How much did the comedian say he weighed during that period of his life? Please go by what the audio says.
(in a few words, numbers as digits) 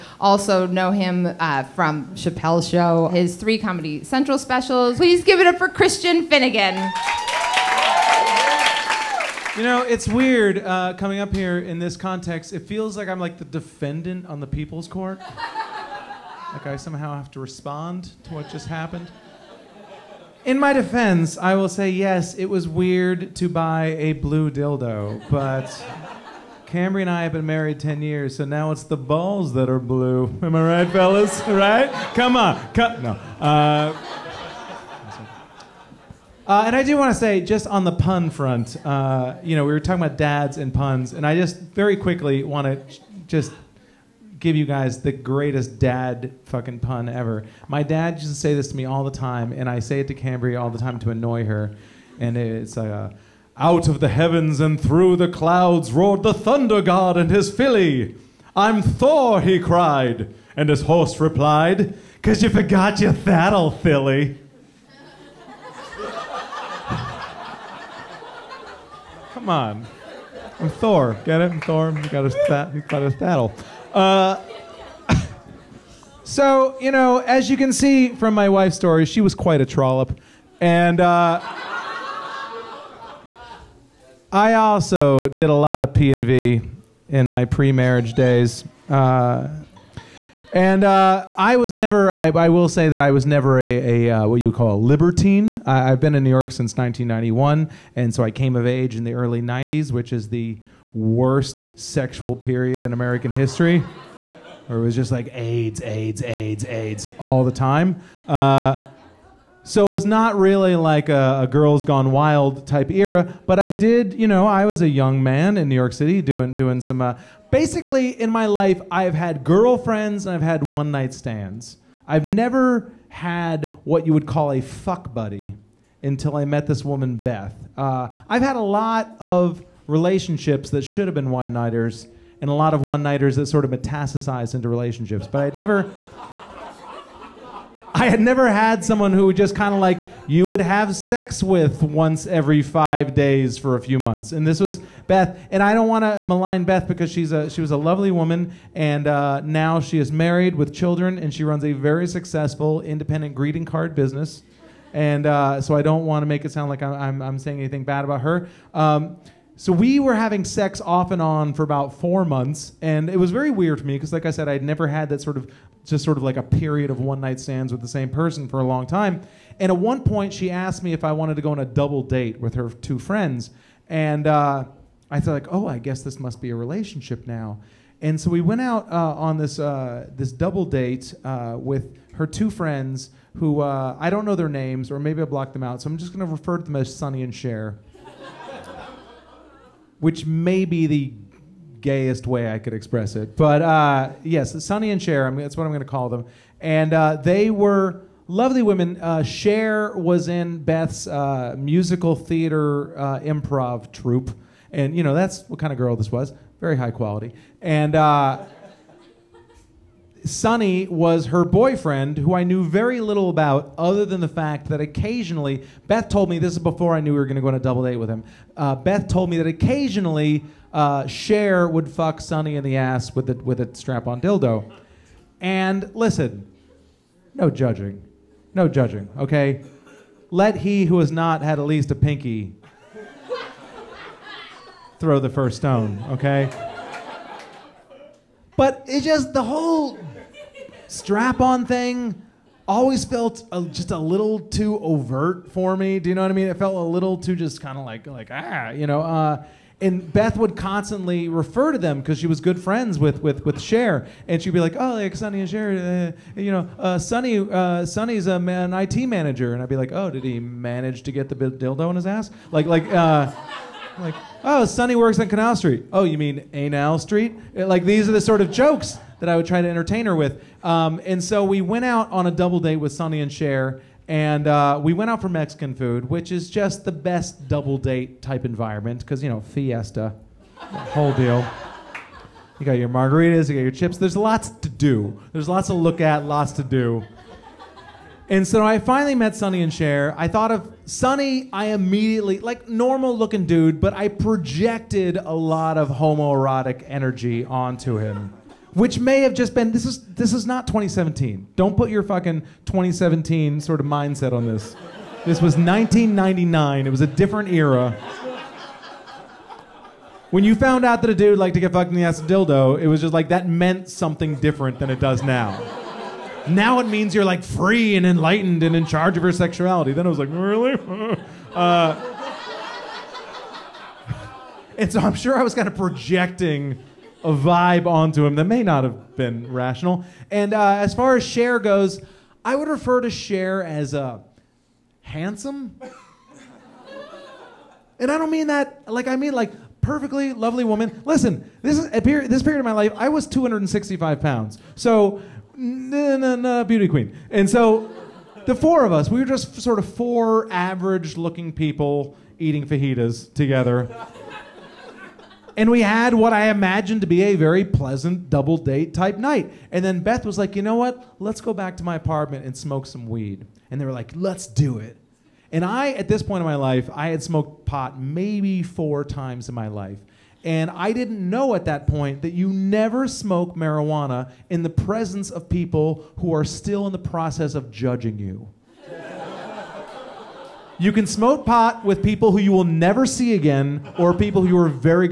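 265 pounds.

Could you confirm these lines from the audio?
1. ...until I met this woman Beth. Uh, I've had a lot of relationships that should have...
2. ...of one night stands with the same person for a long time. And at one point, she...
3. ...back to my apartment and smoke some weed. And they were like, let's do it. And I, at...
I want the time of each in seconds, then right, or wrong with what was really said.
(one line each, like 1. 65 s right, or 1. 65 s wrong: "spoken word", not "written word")
1. 126 s right
2. 166 s right
3. 361 s right.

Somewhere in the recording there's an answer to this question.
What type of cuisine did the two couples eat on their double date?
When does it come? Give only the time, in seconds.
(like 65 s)
275 s.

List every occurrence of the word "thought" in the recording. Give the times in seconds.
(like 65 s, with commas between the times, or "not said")
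175 s, 290 s.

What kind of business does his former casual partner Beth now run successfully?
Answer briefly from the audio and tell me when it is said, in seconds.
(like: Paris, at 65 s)
independent greeting card business, at 152 s.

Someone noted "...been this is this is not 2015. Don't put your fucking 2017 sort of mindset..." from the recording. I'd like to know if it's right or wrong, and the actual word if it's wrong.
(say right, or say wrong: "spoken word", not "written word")
wrong: "2017", not "2015".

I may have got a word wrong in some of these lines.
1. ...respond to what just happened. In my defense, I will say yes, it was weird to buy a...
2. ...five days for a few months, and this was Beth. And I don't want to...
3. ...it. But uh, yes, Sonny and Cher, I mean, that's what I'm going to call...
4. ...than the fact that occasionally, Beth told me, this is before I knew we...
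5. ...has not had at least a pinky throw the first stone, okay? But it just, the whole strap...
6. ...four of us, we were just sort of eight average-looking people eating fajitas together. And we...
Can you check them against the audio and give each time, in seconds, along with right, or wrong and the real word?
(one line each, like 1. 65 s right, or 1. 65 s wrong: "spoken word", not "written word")
1. 17 s right
2. 142 s right
3. 193 s right
4. 214 s right
5. 230 s right
6. 348 s wrong: "four", not "eight".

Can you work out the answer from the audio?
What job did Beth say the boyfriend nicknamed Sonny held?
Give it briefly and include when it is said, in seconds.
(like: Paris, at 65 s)
IT manager, at 258 s.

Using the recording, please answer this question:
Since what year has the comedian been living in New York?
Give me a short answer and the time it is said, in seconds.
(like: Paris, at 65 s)
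1991, at 96 s.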